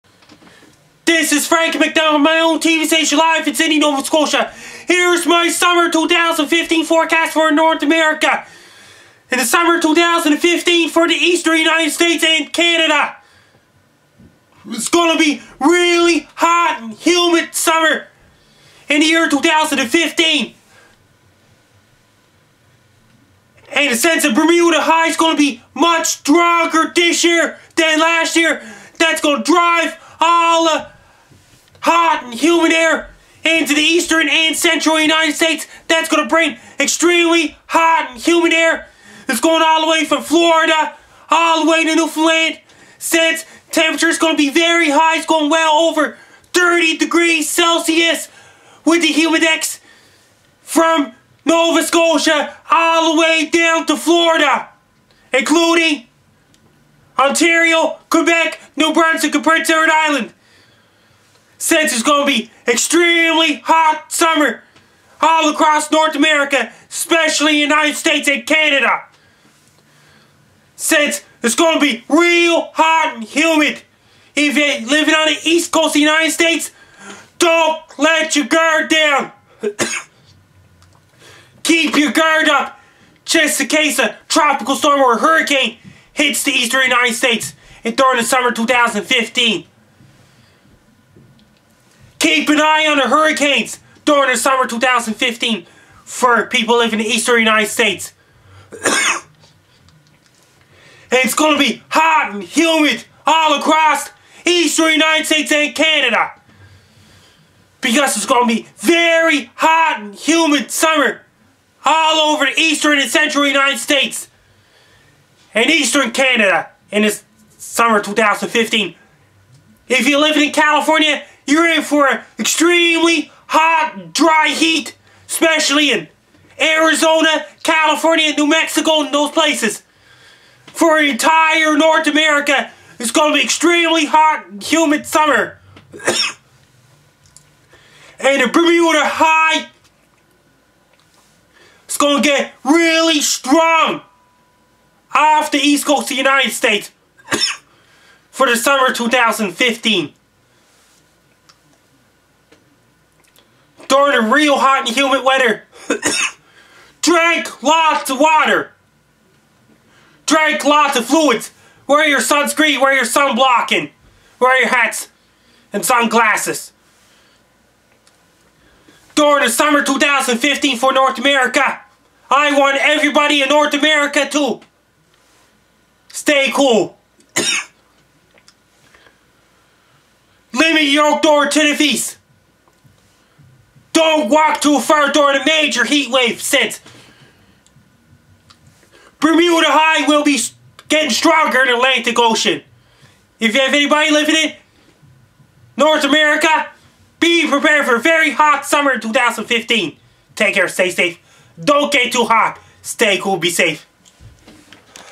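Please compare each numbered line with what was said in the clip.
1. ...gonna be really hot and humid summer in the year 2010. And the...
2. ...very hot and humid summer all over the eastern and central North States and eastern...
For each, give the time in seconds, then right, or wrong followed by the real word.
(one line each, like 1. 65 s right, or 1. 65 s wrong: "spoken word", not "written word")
1. 14 s wrong: "2015", not "2010"
2. 108 s wrong: "United", not "North".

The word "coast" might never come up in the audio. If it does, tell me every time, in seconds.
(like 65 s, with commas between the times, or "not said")
75 s, 145 s.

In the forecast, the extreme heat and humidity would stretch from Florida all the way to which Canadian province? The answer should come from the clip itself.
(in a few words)
Newfoundland.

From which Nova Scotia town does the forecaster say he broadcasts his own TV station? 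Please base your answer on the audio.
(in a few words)
Sydney.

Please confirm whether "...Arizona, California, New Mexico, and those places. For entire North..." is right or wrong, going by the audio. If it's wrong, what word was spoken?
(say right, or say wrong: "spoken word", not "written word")
right.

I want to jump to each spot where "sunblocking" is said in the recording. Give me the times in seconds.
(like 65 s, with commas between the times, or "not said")
163 s.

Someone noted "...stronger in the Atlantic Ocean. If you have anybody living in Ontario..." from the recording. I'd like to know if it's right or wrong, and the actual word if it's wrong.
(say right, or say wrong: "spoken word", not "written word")
wrong: "North", not "Ontario".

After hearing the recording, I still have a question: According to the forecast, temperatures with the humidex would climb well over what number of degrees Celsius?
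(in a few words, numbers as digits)
30.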